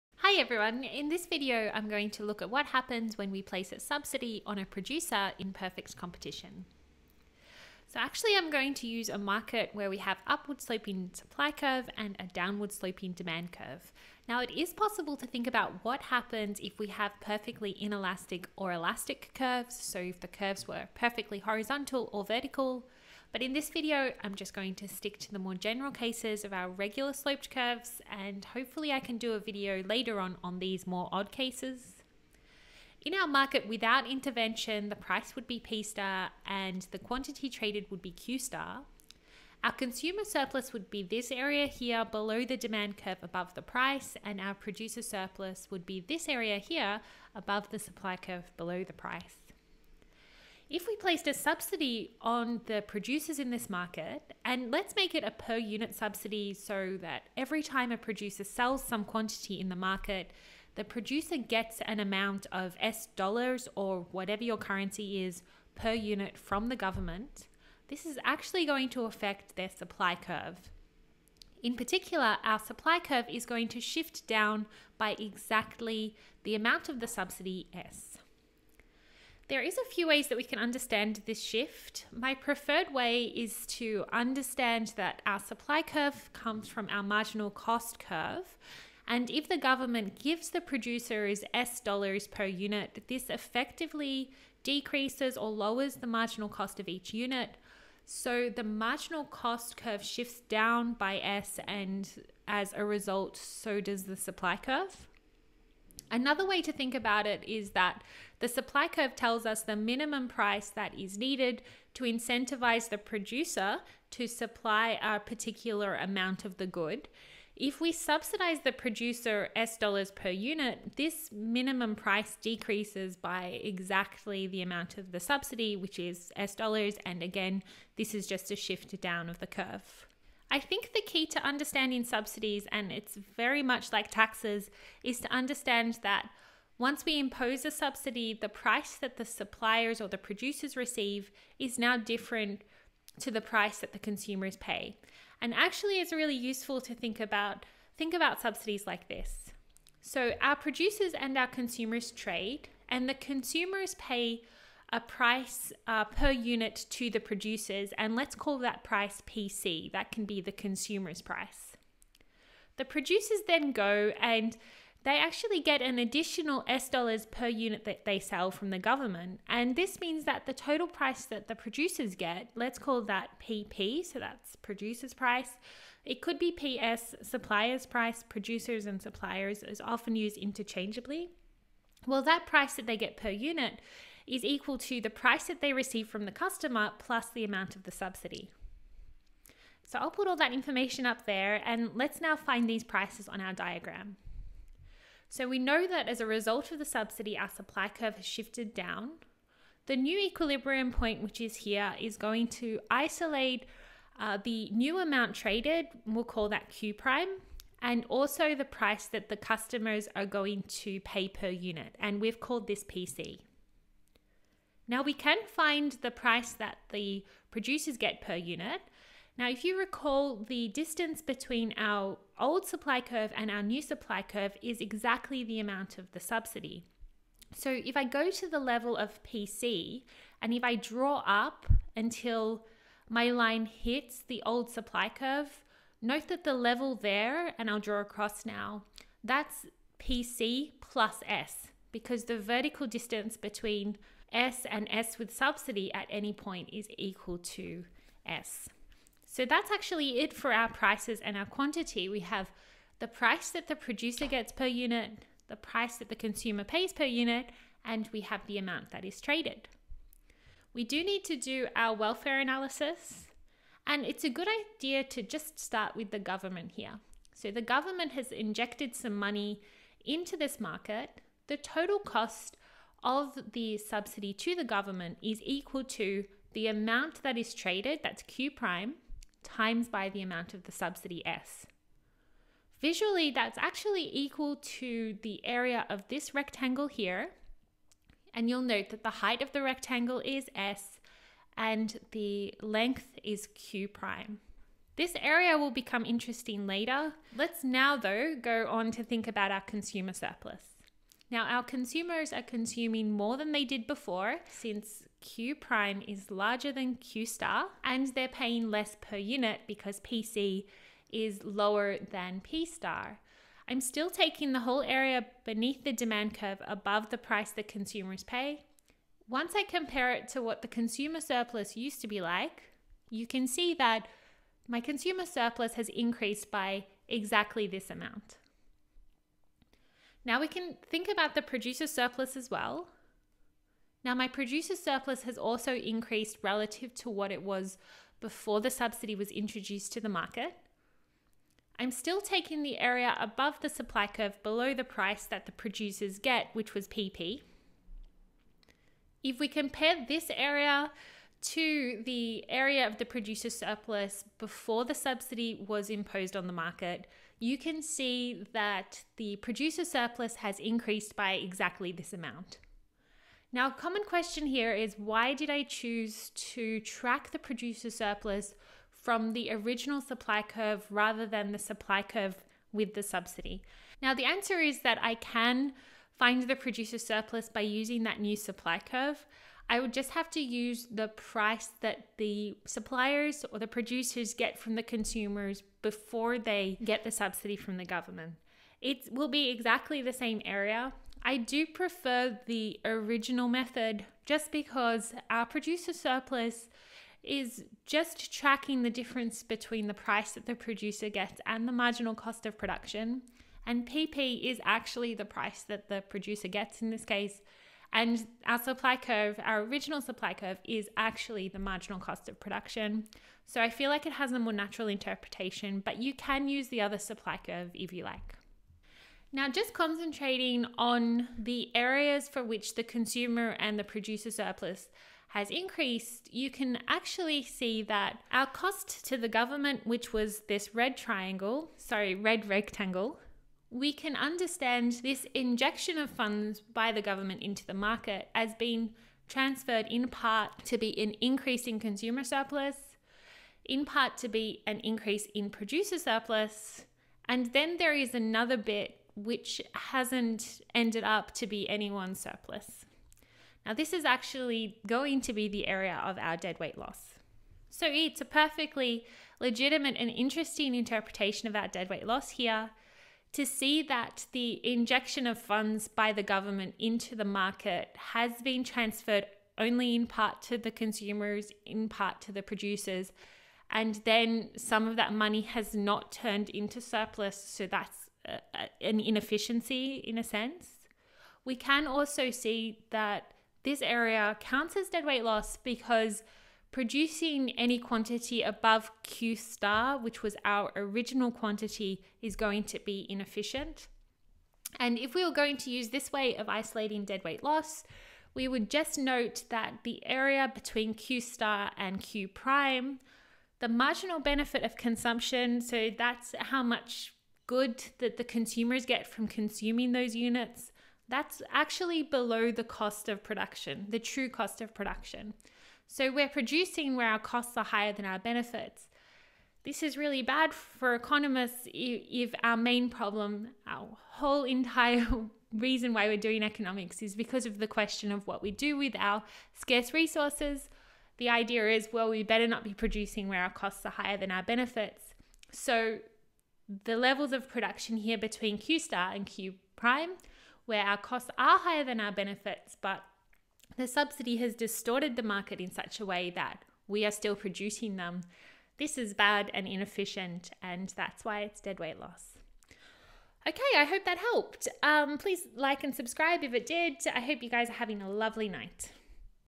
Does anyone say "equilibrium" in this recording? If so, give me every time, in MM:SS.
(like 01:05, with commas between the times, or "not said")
03:20.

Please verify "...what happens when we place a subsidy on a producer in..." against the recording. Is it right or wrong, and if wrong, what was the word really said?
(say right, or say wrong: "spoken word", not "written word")
right.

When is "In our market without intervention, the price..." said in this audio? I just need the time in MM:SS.
00:33.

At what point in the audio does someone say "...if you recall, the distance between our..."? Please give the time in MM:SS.
03:39.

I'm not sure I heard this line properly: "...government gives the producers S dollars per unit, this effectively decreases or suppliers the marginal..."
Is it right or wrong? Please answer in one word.
wrong.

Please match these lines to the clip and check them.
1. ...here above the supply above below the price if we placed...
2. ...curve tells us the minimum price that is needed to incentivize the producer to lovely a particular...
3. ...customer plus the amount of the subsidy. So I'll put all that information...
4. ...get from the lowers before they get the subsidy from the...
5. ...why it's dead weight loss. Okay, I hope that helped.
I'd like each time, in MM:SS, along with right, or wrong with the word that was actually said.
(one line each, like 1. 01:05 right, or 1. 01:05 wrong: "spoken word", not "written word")
1. 00:46 wrong: "curve", not "above"
2. 01:48 wrong: "supply", not "lovely"
3. 03:06 right
4. 06:24 wrong: "consumers", not "lowers"
5. 09:11 right.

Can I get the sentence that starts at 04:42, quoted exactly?
Visually, that's actually equal to the area of this rectangle here.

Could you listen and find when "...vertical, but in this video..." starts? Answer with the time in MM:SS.
00:22.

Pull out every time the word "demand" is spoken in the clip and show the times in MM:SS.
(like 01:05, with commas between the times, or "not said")
00:13, 00:42, 05:15.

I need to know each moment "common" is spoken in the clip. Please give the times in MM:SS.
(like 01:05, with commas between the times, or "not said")
06:03.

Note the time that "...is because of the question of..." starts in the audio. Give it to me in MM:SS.
08:47.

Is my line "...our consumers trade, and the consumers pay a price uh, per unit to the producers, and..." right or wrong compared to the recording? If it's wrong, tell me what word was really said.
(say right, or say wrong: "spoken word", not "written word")
right.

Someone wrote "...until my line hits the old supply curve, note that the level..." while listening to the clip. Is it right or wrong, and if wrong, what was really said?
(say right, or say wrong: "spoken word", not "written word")
right.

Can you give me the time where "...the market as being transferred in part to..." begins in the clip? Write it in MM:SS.
07:17.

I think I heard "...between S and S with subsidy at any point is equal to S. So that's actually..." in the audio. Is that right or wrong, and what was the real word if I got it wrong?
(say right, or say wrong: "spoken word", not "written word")
right.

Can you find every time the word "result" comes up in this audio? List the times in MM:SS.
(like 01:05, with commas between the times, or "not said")
01:42, 03:16.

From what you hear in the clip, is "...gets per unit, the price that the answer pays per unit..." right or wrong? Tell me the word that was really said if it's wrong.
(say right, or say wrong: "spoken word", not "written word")
wrong: "consumer", not "answer".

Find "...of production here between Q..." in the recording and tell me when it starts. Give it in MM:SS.
08:57.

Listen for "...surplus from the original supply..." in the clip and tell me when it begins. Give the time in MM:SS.
06:07.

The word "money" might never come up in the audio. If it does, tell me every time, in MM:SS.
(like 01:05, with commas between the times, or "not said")
04:29, 07:55.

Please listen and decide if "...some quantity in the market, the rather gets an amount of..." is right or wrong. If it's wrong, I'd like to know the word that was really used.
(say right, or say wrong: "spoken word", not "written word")
wrong: "producer", not "rather".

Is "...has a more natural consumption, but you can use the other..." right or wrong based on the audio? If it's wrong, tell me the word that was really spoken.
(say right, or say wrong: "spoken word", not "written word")
wrong: "interpretation", not "consumption".